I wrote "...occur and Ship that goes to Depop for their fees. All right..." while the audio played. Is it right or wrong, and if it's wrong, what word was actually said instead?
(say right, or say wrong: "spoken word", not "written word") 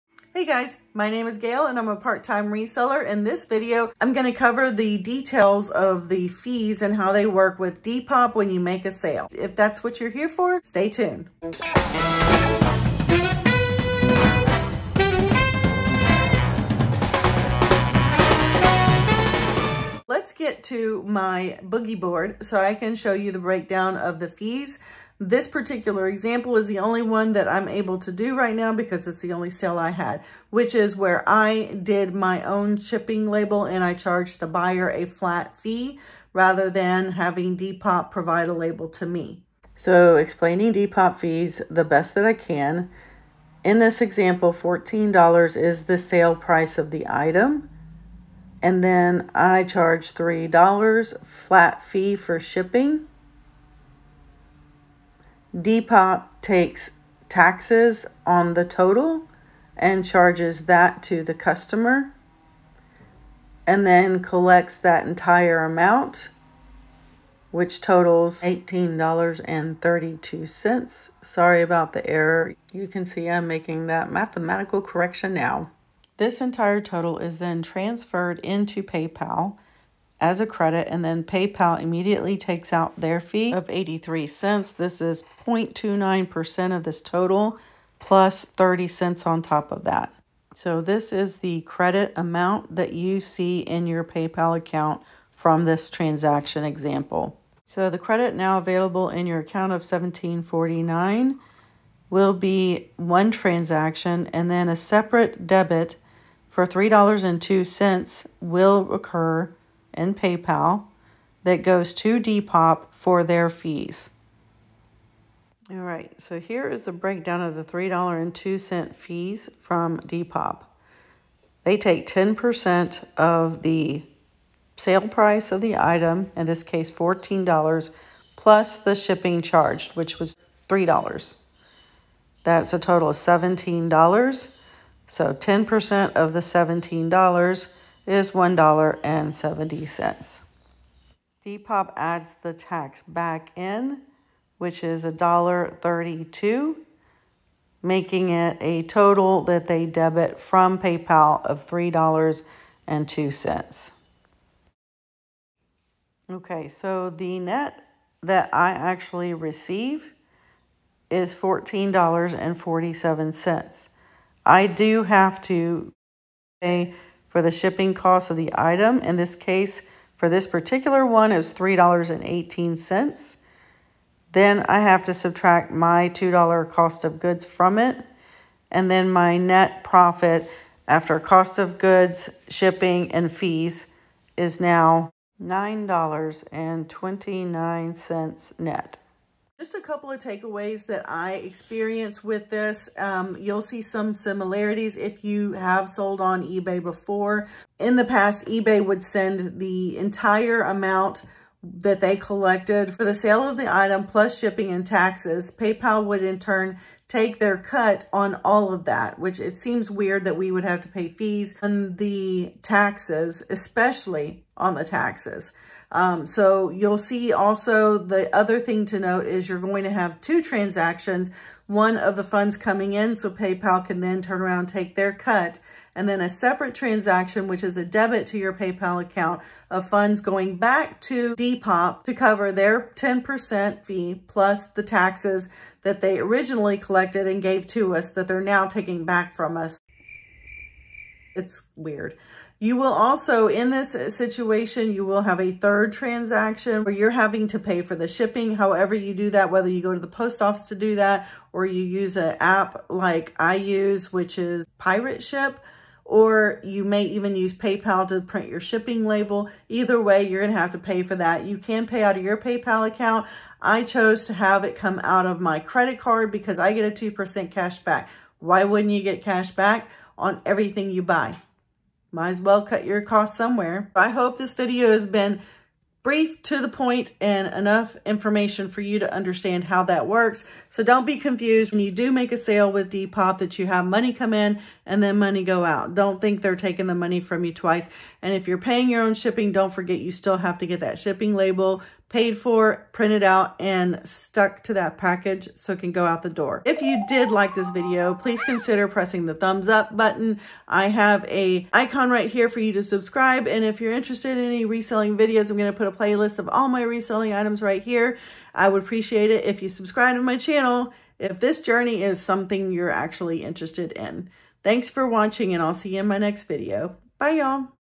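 wrong: "PayPal", not "Ship".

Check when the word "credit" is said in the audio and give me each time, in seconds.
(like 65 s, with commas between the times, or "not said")
80 s, 91 s, 97 s, 265 s.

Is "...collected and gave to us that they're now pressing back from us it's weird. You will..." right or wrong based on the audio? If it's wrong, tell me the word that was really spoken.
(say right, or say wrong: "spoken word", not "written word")
wrong: "taking", not "pressing".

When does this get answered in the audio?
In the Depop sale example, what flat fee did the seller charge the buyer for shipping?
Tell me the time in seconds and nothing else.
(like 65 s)
50 s.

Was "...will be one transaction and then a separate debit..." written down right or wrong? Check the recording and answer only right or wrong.
right.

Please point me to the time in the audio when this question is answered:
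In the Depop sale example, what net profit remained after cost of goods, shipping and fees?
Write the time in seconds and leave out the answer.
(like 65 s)
185 s.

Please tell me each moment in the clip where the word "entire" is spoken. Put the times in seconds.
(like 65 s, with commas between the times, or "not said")
65 s, 76 s, 199 s.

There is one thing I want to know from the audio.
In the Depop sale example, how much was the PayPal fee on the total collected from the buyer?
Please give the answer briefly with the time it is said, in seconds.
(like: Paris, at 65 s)
83 cents, at 83 s.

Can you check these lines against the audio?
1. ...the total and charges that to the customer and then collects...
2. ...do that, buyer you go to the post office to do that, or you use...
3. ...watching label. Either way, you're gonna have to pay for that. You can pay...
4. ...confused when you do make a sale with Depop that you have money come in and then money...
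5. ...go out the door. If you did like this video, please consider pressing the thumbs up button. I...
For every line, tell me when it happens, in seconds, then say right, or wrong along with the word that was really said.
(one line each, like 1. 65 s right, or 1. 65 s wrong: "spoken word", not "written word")
1. 58 s right
2. 249 s wrong: "whether", not "buyer"
3. 258 s wrong: "shipping", not "watching"
4. 281 s right
5. 295 s right.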